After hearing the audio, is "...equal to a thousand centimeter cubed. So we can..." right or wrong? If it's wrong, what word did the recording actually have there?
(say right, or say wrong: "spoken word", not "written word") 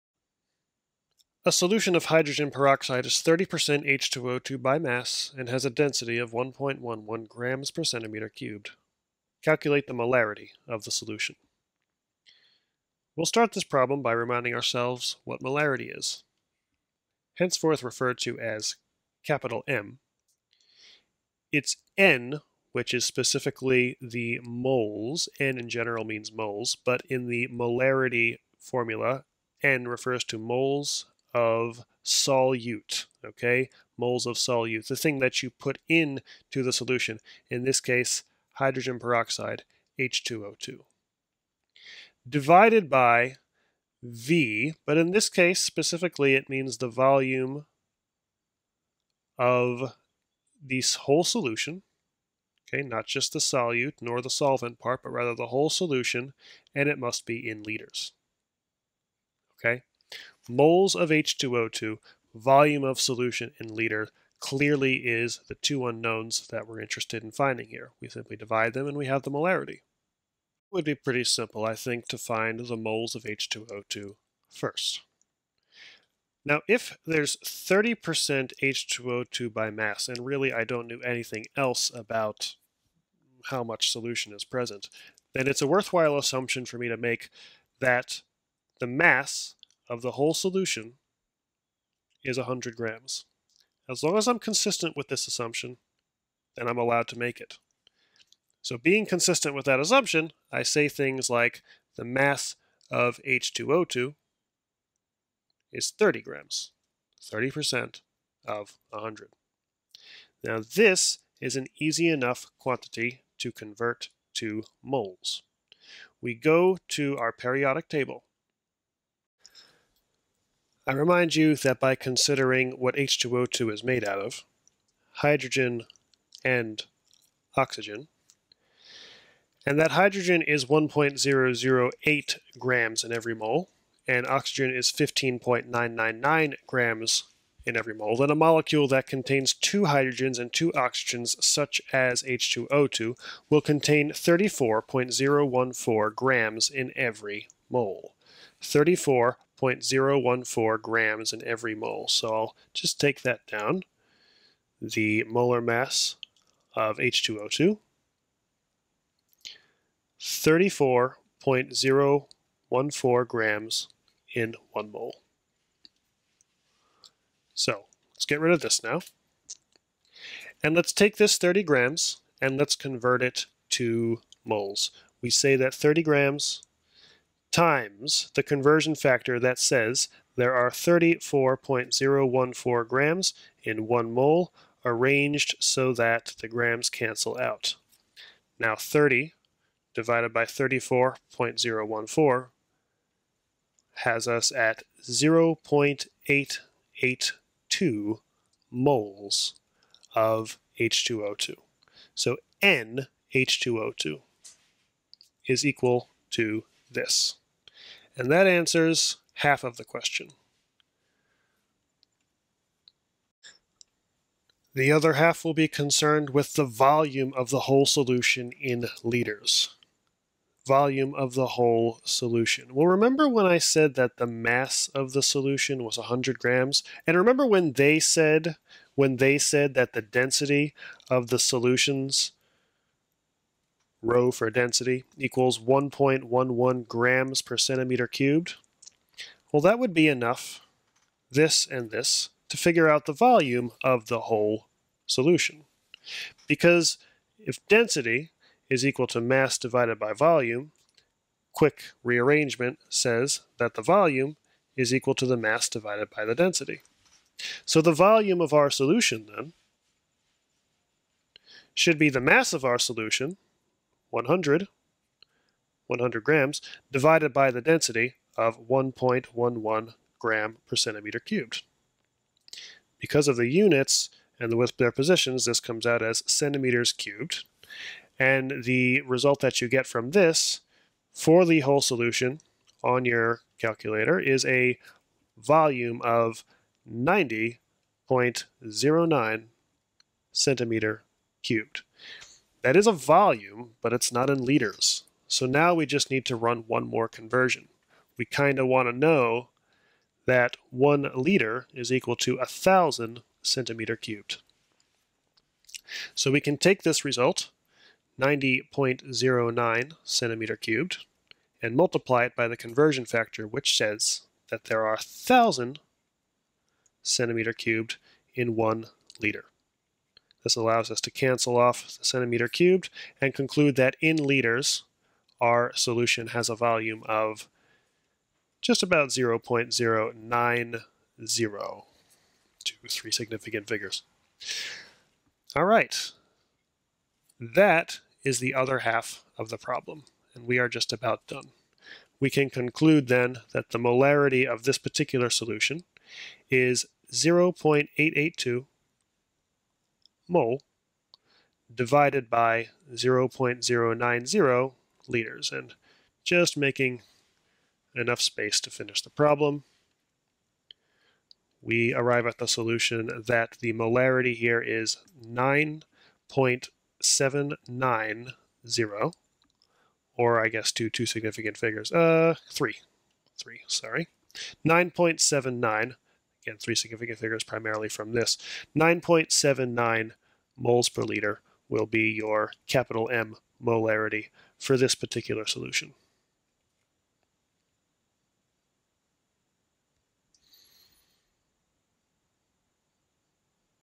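right.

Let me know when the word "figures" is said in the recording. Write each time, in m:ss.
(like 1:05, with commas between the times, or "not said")
4:02, 5:33, 6:11, 6:17.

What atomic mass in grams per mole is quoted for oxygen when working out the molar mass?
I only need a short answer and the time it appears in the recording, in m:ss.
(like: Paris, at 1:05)
15.999, at 2:14.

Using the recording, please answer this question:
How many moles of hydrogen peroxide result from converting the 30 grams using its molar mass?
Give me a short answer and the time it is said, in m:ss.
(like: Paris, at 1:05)
0.882 moles, at 3:15.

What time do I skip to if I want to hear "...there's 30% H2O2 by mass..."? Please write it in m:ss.
1:17.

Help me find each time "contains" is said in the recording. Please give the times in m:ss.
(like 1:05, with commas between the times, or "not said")
2:19, 2:23.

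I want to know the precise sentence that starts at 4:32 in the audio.
Because of the units and the with their positions, this comes out as centimeters cubed.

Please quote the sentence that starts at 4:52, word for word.
That is a volume, but it's not in liters.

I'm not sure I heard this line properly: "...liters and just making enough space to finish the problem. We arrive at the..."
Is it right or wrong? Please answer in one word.
right.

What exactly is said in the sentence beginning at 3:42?
Well, remember when I said that the mass of the solution was 100 grams?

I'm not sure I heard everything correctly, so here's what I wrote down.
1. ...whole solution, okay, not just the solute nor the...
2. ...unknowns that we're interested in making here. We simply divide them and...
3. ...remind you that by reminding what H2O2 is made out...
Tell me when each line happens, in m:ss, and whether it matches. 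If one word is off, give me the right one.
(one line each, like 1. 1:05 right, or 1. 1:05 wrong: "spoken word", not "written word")
1. 0:50 right
2. 1:05 wrong: "finding", not "making"
3. 2:00 wrong: "considering", not "reminding".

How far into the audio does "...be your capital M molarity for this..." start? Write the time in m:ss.
6:21.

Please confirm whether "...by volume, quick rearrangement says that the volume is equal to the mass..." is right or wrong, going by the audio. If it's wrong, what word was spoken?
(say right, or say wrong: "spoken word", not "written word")
right.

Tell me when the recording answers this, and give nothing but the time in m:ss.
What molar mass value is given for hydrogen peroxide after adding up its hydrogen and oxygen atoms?
2:24.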